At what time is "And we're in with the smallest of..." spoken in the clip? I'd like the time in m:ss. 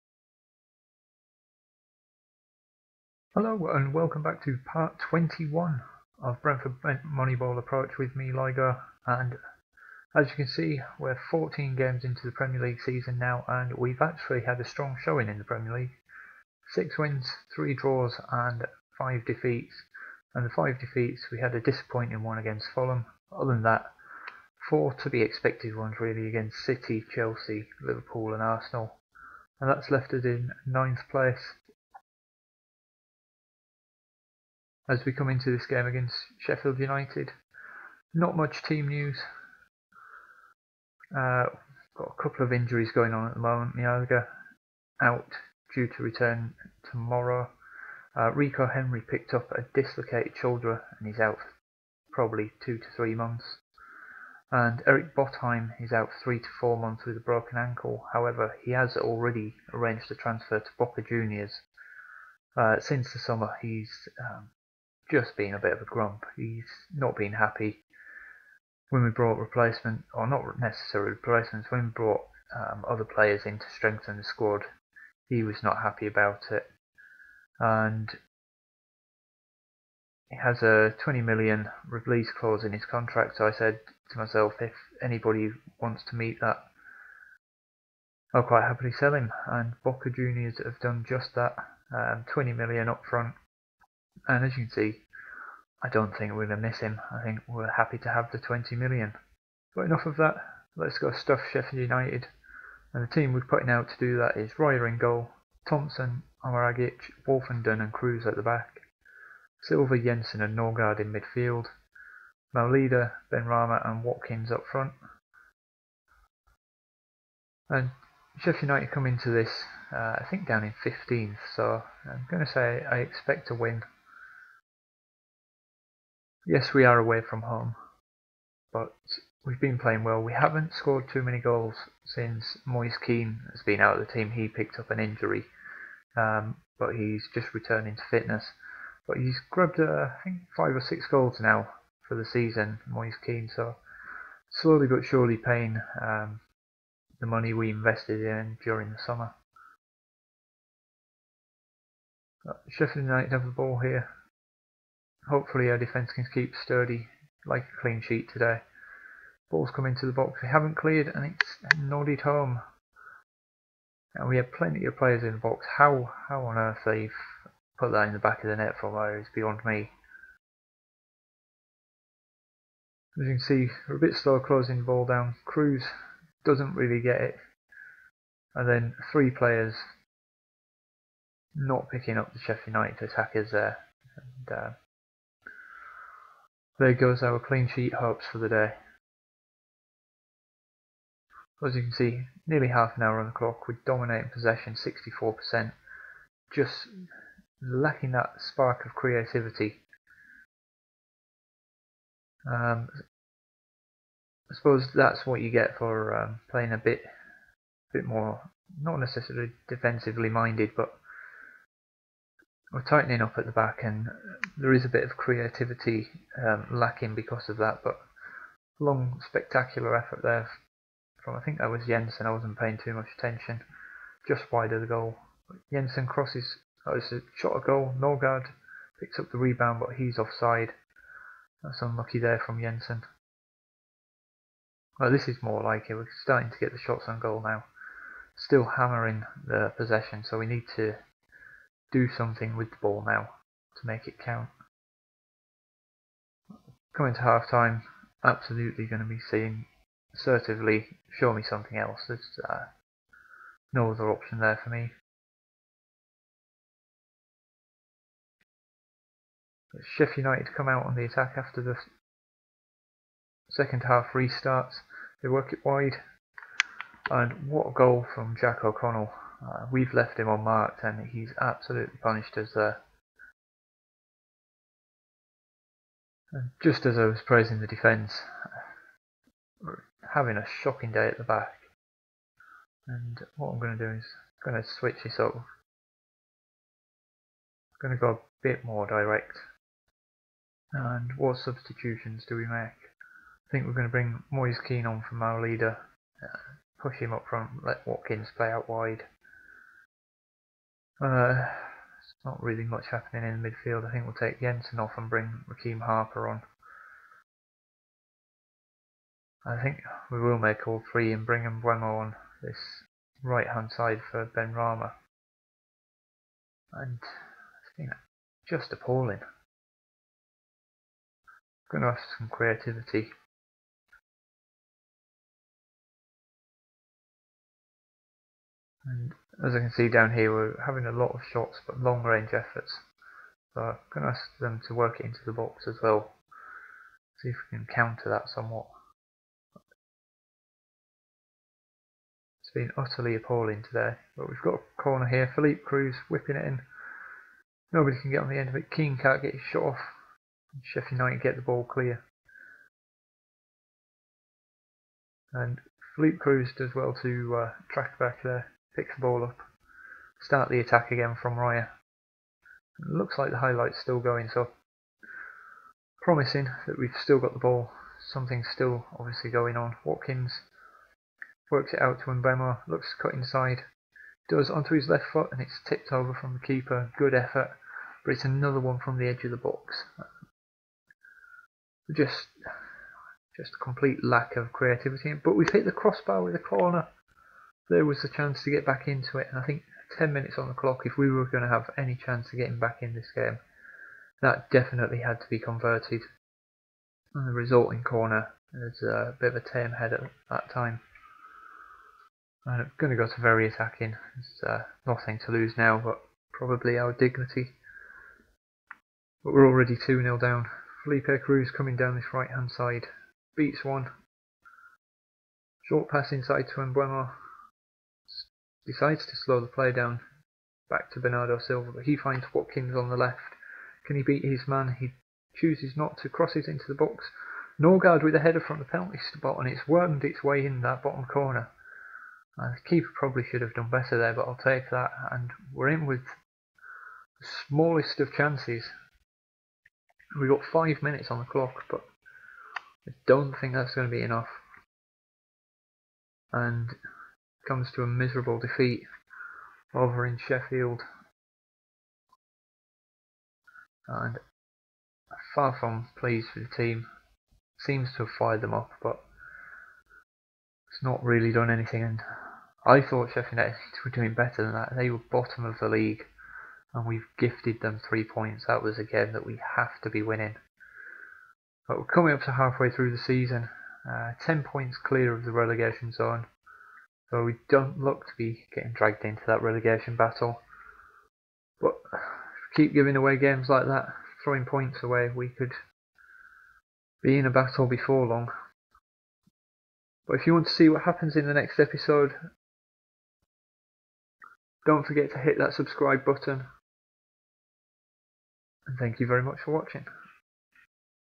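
7:15.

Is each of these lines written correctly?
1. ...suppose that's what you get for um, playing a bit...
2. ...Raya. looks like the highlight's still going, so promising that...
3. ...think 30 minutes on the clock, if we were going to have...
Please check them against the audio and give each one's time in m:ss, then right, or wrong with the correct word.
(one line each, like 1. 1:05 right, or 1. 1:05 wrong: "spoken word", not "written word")
1. 3:24 right
2. 6:01 right
3. 6:29 wrong: "10", not "30".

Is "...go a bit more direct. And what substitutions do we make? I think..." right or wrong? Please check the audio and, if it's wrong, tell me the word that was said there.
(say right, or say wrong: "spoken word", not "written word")
right.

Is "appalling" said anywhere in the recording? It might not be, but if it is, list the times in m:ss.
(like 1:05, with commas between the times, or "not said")
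5:18, 5:43.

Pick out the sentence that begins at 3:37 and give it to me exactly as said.
But long, spectacular effort there from I think that was Jensen.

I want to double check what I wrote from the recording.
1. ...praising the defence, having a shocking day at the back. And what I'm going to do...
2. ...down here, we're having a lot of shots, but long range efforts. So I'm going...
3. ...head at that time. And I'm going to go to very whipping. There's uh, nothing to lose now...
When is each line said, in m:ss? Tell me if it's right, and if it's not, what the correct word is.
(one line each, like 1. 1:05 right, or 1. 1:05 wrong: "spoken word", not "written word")
1. 4:37 right
2. 5:29 right
3. 6:39 wrong: "attacking", not "whipping".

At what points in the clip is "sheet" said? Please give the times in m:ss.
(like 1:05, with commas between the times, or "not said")
2:38, 3:07.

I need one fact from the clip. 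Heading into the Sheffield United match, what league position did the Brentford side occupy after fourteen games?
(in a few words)
9th.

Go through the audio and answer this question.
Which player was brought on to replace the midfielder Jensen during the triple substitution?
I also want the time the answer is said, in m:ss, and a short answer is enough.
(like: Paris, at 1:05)
Raheem Harper, at 5:05.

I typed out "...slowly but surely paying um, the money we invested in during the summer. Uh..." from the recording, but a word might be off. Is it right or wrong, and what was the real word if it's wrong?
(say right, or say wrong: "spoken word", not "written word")
right.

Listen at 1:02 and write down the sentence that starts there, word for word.
Uh, since the summer, he's um, just being a bit of a grump.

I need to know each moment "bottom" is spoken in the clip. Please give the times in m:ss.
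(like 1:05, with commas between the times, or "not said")
7:10, 7:45.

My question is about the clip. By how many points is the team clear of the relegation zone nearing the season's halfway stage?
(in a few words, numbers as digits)
10 points.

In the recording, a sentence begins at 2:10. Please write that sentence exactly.
We haven't scored too many goals since Moise Kean has been out of the team.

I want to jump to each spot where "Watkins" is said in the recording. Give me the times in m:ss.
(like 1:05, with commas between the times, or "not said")
1:54, 4:57, 6:09, 7:02.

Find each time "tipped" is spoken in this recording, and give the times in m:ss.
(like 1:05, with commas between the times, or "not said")
6:15.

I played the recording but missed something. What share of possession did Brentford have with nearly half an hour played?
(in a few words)
64%.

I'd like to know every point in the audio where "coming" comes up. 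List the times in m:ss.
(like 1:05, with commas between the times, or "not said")
4:06, 6:51, 7:51.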